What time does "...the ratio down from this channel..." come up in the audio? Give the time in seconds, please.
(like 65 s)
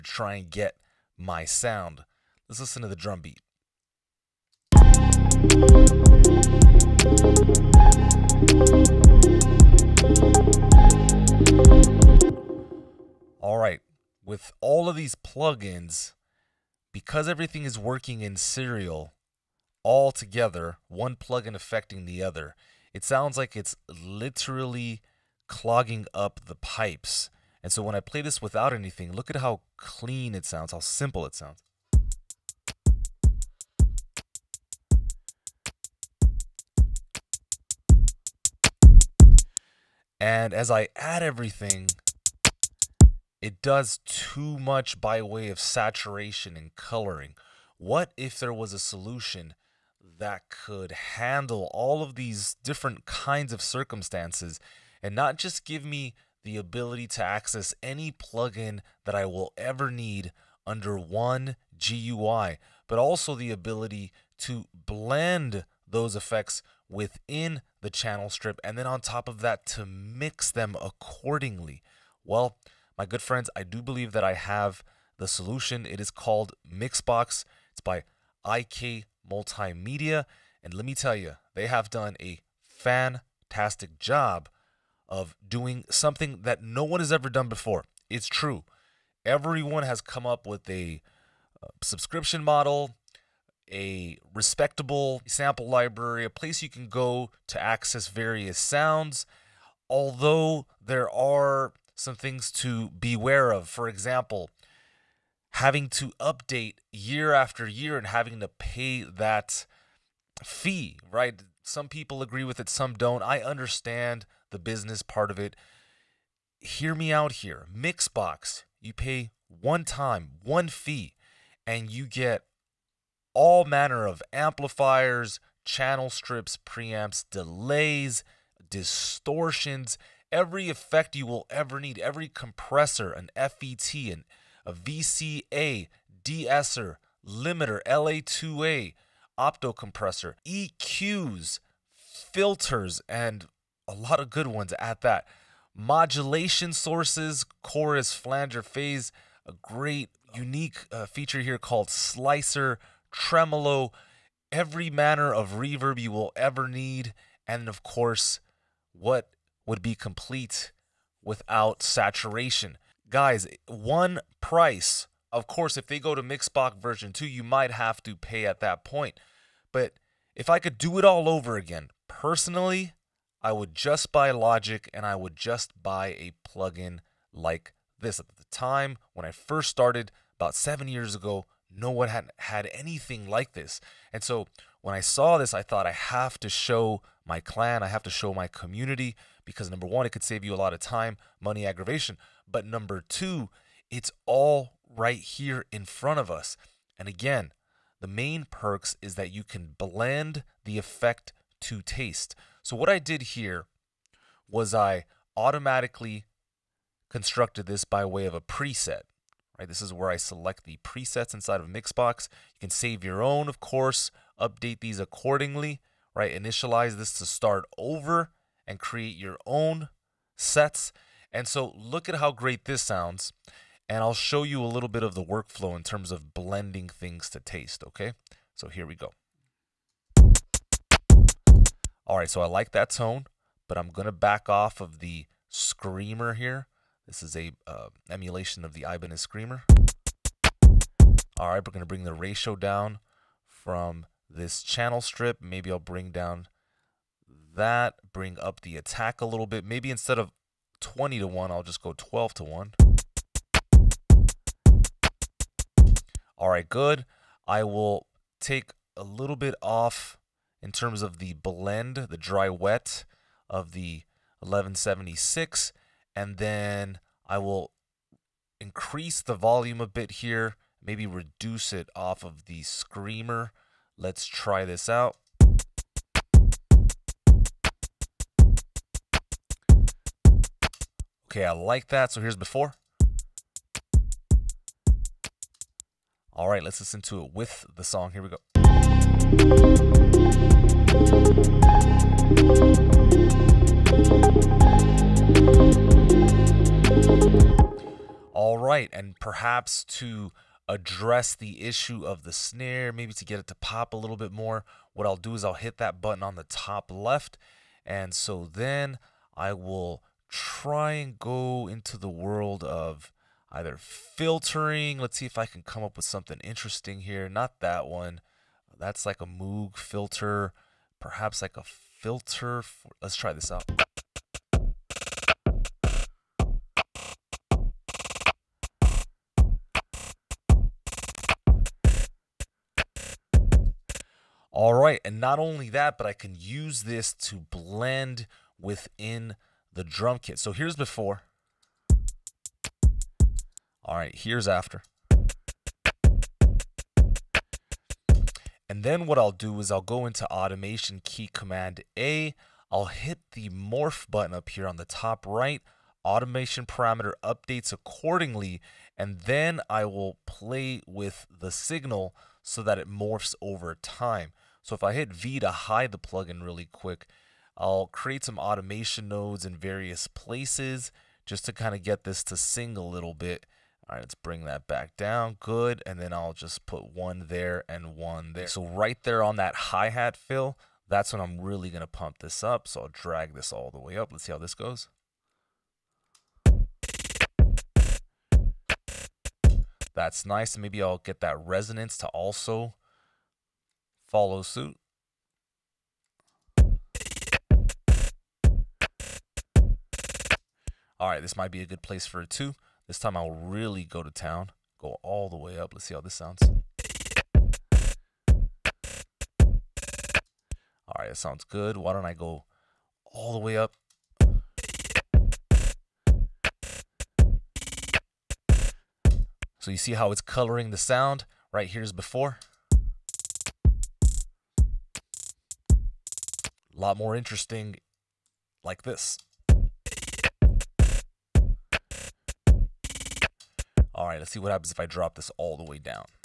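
242 s.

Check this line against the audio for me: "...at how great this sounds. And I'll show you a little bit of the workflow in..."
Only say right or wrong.
right.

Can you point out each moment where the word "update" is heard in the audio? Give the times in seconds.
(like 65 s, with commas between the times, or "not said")
106 s, 214 s, 357 s.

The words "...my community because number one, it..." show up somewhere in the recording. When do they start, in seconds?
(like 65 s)
188 s.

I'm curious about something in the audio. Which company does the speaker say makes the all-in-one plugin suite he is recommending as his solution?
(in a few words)
IK Multimedia.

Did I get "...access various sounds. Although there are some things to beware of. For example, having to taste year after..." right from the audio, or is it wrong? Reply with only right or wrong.
wrong.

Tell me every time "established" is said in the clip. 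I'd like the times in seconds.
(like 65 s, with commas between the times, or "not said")
not said.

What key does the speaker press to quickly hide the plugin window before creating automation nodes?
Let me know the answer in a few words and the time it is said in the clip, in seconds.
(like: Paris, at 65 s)
V, at 365 s.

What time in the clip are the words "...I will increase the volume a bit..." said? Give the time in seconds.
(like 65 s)
267 s.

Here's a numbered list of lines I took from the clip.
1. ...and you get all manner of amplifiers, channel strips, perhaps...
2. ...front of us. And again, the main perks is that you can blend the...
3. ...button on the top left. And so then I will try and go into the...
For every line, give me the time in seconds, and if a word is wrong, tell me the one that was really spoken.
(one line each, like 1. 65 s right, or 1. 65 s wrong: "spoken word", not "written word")
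1. 121 s wrong: "preamps", not "perhaps"
2. 195 s right
3. 306 s right.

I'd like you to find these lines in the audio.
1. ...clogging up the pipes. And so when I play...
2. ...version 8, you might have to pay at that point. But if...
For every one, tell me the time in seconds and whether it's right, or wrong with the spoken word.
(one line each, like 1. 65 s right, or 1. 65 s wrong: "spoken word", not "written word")
1. 25 s right
2. 166 s wrong: "2", not "8".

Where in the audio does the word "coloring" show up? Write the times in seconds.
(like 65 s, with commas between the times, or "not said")
46 s, 420 s.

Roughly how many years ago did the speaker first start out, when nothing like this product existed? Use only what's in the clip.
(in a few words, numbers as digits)
7.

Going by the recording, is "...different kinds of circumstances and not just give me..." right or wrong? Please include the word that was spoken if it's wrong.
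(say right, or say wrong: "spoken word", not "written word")
right.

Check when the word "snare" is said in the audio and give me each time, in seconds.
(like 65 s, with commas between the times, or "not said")
302 s.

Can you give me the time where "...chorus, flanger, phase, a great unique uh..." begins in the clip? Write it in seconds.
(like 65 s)
147 s.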